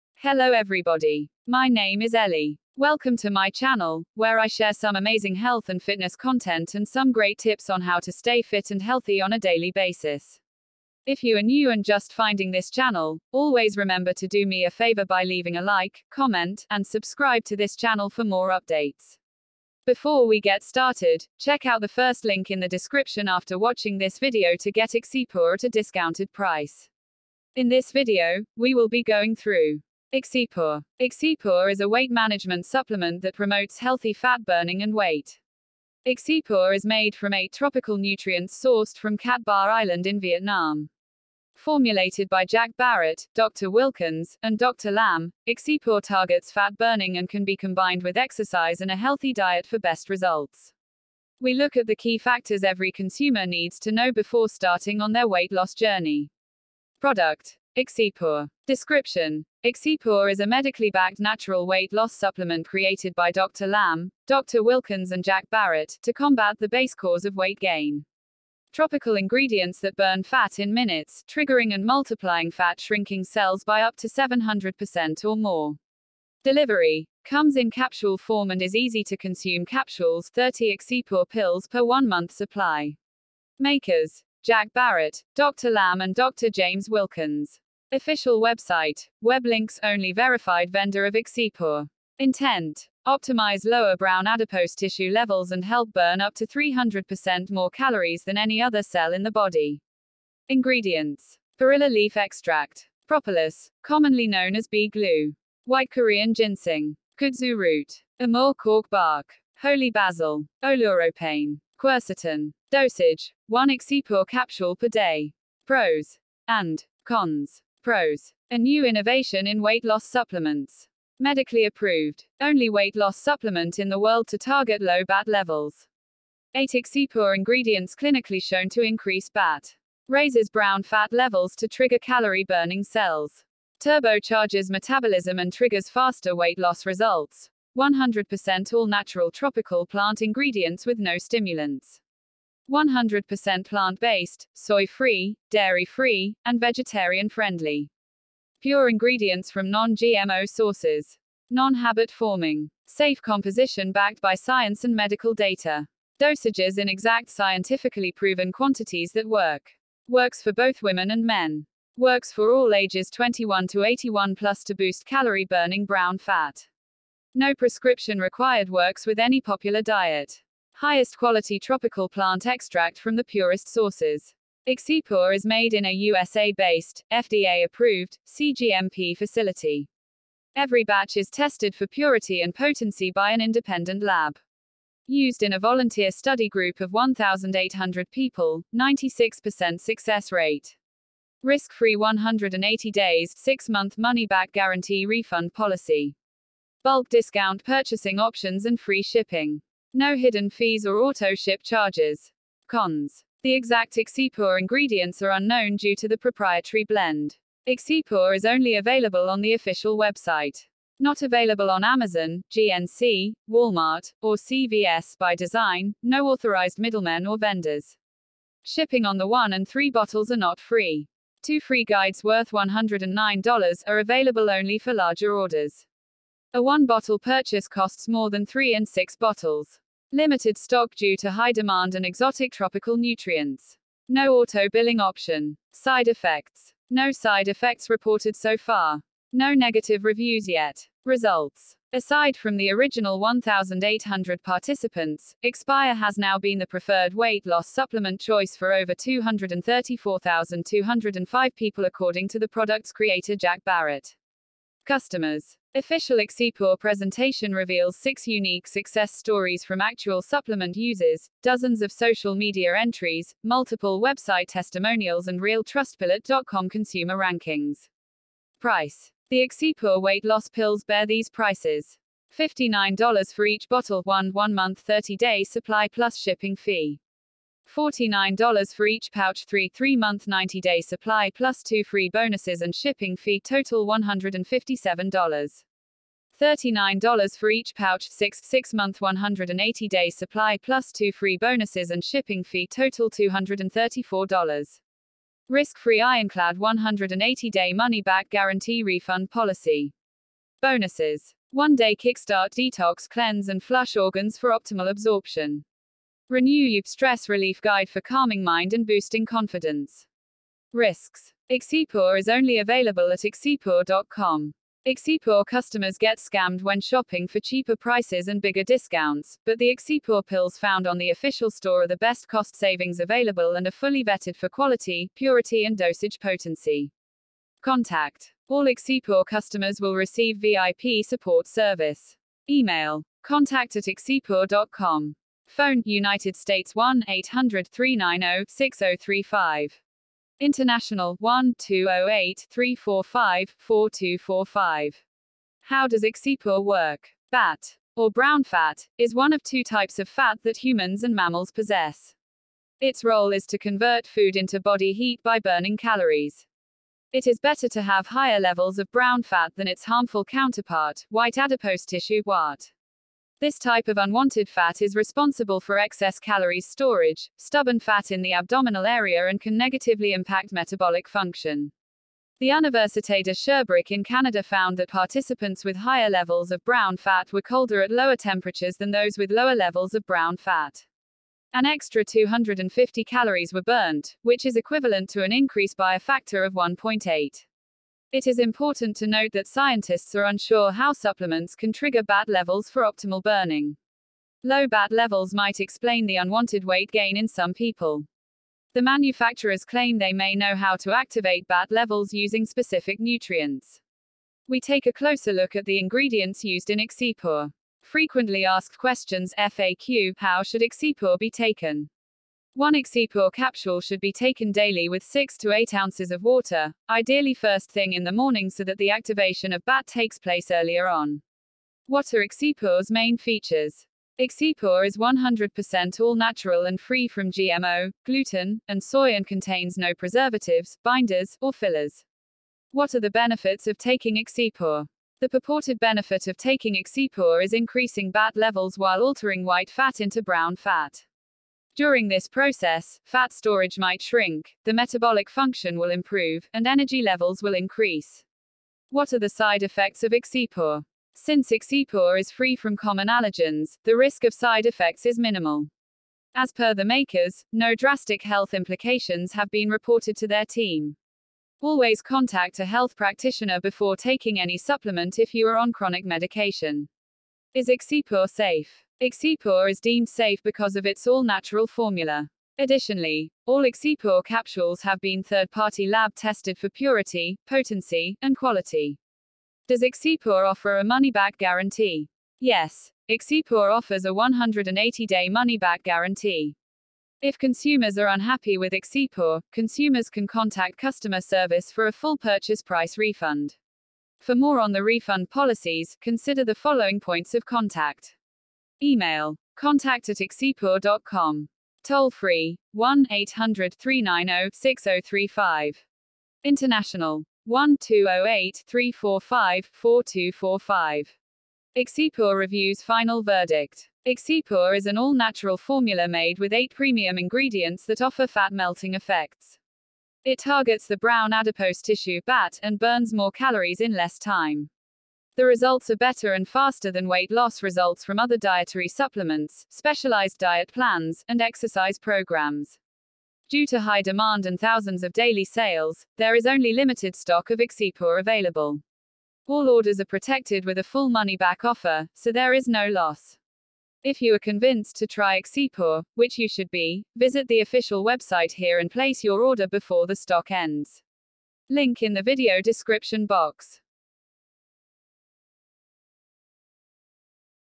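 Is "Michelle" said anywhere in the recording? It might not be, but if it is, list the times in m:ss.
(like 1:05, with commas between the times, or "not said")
not said.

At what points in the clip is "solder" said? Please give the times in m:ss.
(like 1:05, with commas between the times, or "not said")
not said.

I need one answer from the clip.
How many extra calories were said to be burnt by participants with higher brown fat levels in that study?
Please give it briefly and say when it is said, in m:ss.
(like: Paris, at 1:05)
250, at 6:22.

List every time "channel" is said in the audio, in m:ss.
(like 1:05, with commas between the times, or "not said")
0:03, 0:12, 0:17.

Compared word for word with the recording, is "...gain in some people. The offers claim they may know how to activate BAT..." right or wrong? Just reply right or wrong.
wrong.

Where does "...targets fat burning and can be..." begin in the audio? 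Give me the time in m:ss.
0:46.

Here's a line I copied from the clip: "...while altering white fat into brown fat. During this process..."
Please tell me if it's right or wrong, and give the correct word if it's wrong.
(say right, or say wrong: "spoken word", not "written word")
right.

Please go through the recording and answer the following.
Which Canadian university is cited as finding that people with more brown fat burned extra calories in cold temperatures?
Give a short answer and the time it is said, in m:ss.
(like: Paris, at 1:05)
Université de Sherbrooke, at 6:12.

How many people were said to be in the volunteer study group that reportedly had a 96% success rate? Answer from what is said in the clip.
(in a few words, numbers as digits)
1,800.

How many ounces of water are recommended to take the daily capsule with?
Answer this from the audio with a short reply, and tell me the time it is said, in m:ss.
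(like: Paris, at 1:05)
6 to 8, at 6:55.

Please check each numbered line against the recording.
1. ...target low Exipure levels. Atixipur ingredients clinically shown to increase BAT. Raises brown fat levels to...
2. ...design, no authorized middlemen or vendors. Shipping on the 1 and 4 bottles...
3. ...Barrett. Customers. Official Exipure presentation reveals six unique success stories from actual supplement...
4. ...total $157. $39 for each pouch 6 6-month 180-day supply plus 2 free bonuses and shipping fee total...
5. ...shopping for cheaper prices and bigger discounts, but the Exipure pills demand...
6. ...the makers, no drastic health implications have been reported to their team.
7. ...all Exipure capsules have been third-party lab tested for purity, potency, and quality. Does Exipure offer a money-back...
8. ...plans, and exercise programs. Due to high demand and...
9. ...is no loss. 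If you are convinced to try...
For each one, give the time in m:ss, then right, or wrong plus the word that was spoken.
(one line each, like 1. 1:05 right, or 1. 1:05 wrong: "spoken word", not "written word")
1. 2:04 wrong: "BAT", not "Exipure"
2. 3:35 wrong: "3", not "4"
3. 4:13 right
4. 4:43 right
5. 5:16 wrong: "found", not "demand"
6. 7:36 right
7. 7:53 right
8. 8:50 right
9. 9:02 right.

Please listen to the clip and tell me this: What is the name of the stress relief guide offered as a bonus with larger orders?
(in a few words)
Renew You.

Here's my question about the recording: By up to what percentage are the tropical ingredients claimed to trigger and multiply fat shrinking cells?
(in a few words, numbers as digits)
700%.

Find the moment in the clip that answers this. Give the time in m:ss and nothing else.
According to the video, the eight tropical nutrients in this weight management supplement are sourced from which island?
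0:39.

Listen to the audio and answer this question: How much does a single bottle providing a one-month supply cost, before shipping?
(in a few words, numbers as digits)
$59.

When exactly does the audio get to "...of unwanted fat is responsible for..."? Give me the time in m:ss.
6:03.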